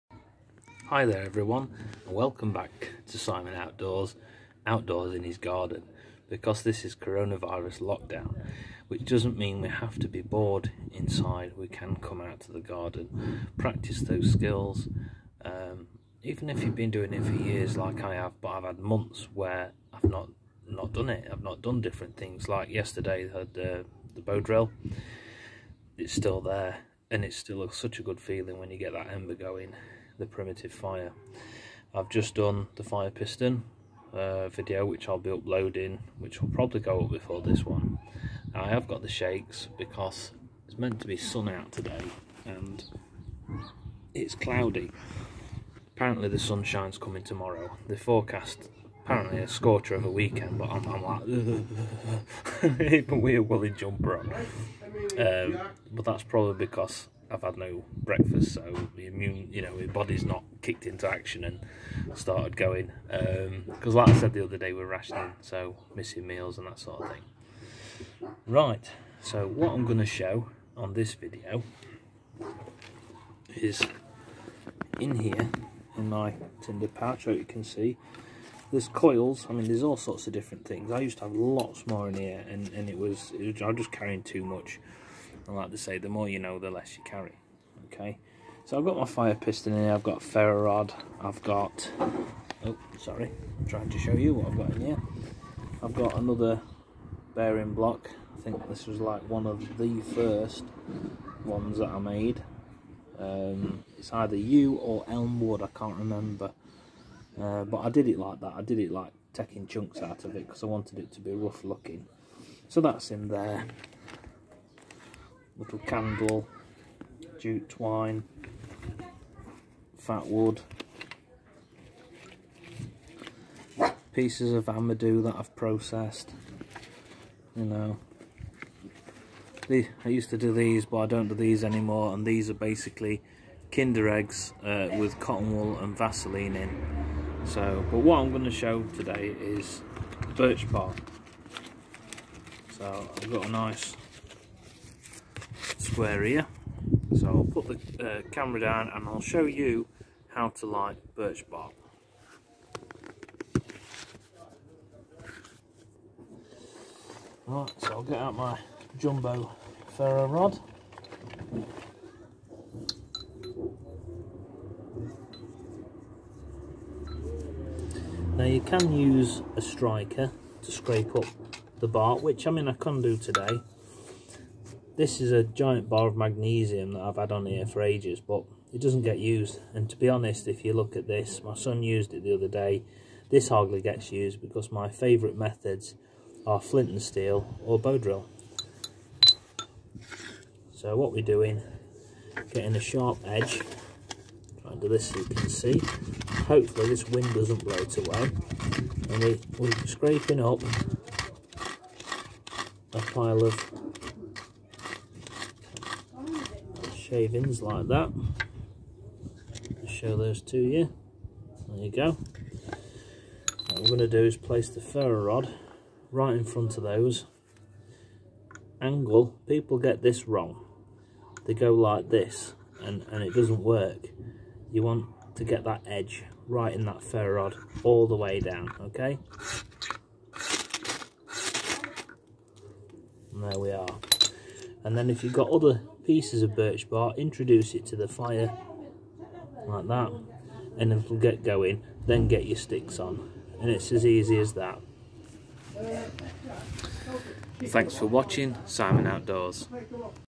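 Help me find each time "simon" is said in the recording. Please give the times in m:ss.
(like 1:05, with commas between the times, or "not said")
0:03, 4:08.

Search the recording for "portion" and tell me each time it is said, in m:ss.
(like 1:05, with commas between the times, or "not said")
not said.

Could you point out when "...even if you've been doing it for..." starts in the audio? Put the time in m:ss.
0:16.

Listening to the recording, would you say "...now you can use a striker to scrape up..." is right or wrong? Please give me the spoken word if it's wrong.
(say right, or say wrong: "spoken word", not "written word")
right.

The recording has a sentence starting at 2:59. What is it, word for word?
And to be honest, if you look at this, my son used it the other day.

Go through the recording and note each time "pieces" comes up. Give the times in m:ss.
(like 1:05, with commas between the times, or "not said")
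2:04, 3:56.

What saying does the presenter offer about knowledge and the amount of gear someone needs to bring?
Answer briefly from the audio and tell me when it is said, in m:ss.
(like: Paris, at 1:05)
the more you know, the less you carry, at 1:25.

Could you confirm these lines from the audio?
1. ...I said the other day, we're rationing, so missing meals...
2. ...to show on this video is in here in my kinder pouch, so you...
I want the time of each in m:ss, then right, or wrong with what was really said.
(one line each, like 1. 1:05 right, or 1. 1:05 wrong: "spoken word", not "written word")
1. 1:04 right
2. 1:09 wrong: "tinder", not "kinder".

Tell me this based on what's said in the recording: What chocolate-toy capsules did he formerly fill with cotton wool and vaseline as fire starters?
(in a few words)
kinder eggs.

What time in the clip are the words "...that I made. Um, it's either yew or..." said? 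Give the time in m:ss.
1:41.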